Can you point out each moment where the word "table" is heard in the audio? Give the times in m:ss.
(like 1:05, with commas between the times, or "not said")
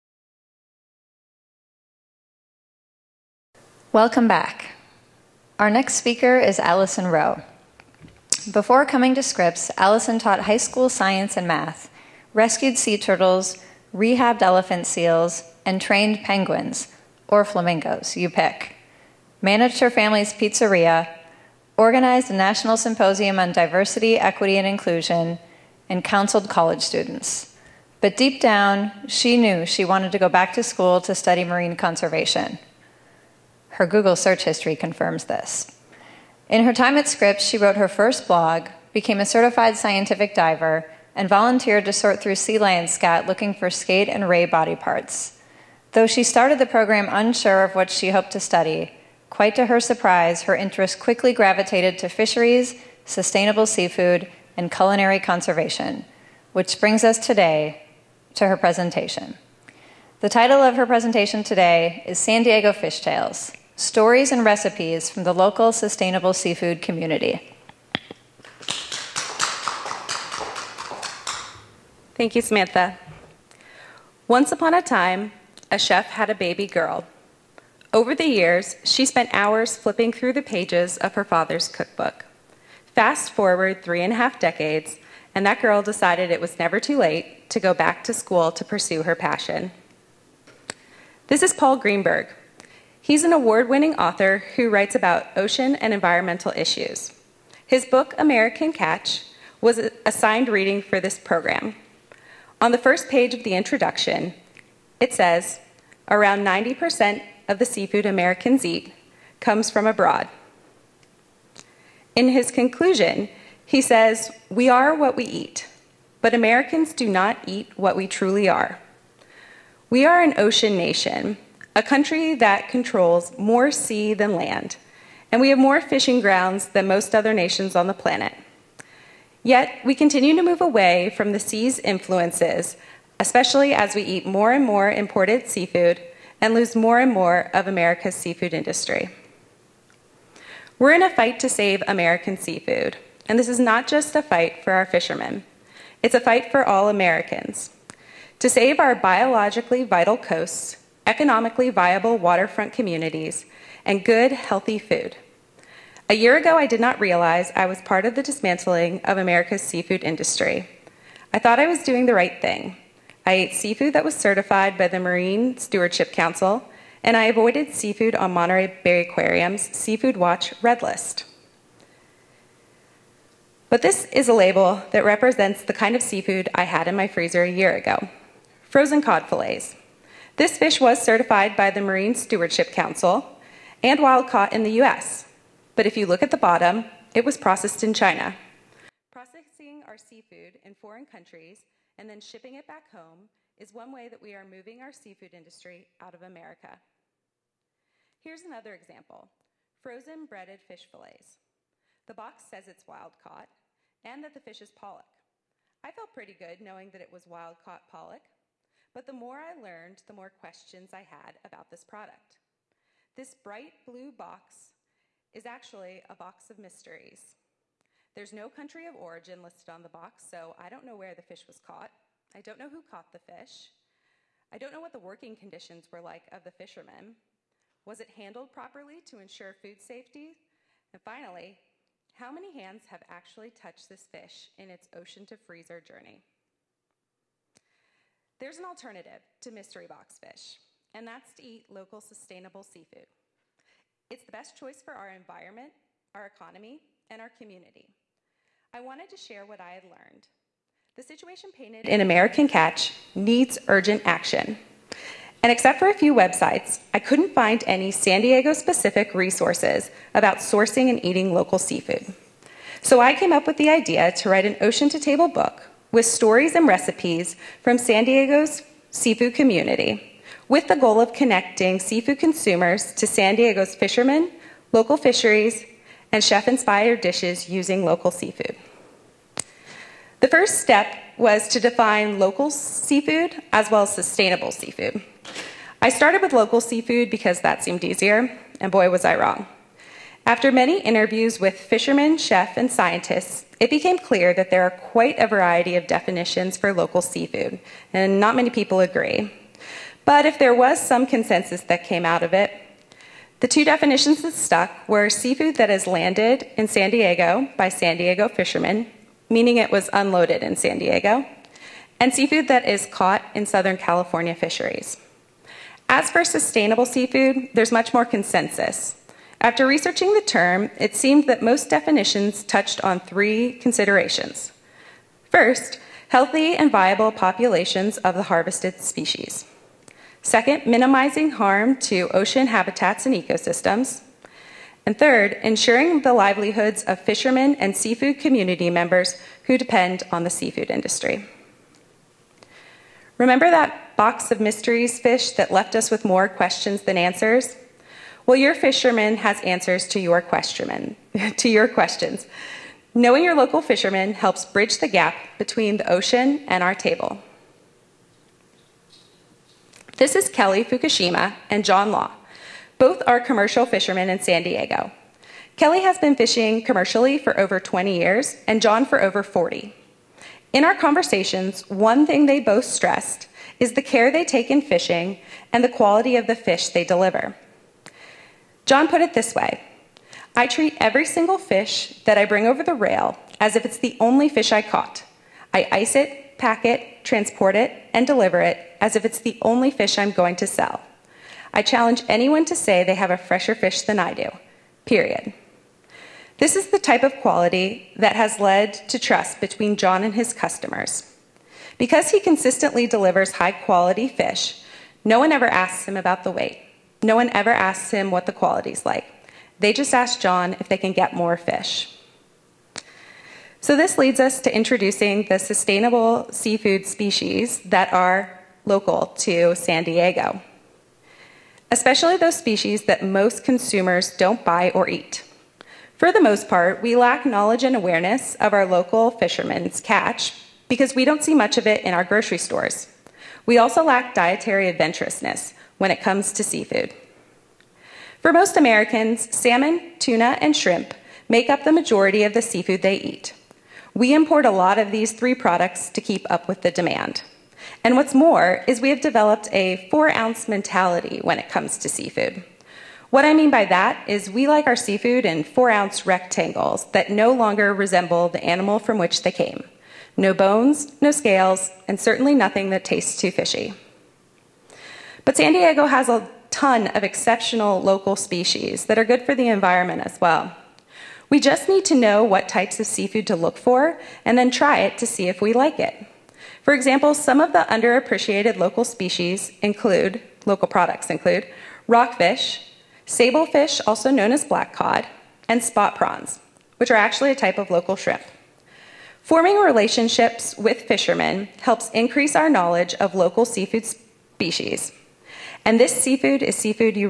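4:24, 5:56.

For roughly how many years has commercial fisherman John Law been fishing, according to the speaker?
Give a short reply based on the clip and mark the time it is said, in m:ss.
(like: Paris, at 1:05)
over 40, at 6:09.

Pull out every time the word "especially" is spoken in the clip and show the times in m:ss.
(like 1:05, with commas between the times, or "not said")
2:13, 7:01.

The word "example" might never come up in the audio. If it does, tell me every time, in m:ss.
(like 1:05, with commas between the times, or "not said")
3:18, 7:56.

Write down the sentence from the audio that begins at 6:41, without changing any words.
Because he consistently delivers high quality fish, no one ever asks him about the weight.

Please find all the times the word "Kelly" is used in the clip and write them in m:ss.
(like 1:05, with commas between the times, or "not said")
6:00, 6:05.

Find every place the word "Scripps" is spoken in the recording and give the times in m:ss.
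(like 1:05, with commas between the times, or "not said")
0:09, 0:37.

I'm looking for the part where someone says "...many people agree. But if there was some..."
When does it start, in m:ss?
4:58.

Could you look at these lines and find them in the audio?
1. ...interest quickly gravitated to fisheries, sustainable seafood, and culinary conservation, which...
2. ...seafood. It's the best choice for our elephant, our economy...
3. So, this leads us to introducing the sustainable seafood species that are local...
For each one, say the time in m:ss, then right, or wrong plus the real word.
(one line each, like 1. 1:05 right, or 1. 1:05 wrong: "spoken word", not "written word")
1. 0:50 right
2. 4:02 wrong: "environment", not "elephant"
3. 6:53 right.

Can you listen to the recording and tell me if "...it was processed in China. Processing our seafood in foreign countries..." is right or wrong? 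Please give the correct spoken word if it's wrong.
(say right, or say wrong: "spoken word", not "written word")
right.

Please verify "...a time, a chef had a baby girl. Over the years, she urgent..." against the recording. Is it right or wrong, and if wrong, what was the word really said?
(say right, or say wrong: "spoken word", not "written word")
wrong: "spent", not "urgent".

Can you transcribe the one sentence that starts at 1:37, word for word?
His book, American Catch, was assigned reading for this program.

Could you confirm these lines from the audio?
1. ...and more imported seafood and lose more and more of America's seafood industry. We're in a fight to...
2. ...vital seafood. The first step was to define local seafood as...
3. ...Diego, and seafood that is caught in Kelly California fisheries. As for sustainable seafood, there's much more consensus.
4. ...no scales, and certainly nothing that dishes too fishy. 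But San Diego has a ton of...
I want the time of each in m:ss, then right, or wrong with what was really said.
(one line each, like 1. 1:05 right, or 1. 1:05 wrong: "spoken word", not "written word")
1. 2:14 right
2. 4:37 wrong: "local", not "vital"
3. 5:10 wrong: "Southern", not "Kelly"
4. 7:41 wrong: "tastes", not "dishes".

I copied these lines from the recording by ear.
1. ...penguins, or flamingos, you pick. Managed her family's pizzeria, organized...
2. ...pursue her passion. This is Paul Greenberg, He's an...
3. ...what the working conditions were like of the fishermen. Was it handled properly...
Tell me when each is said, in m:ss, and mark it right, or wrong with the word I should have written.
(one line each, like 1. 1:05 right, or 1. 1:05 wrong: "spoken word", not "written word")
1. 0:16 right
2. 1:28 right
3. 3:44 right.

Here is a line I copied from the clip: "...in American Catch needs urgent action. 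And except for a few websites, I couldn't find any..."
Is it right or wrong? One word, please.
right.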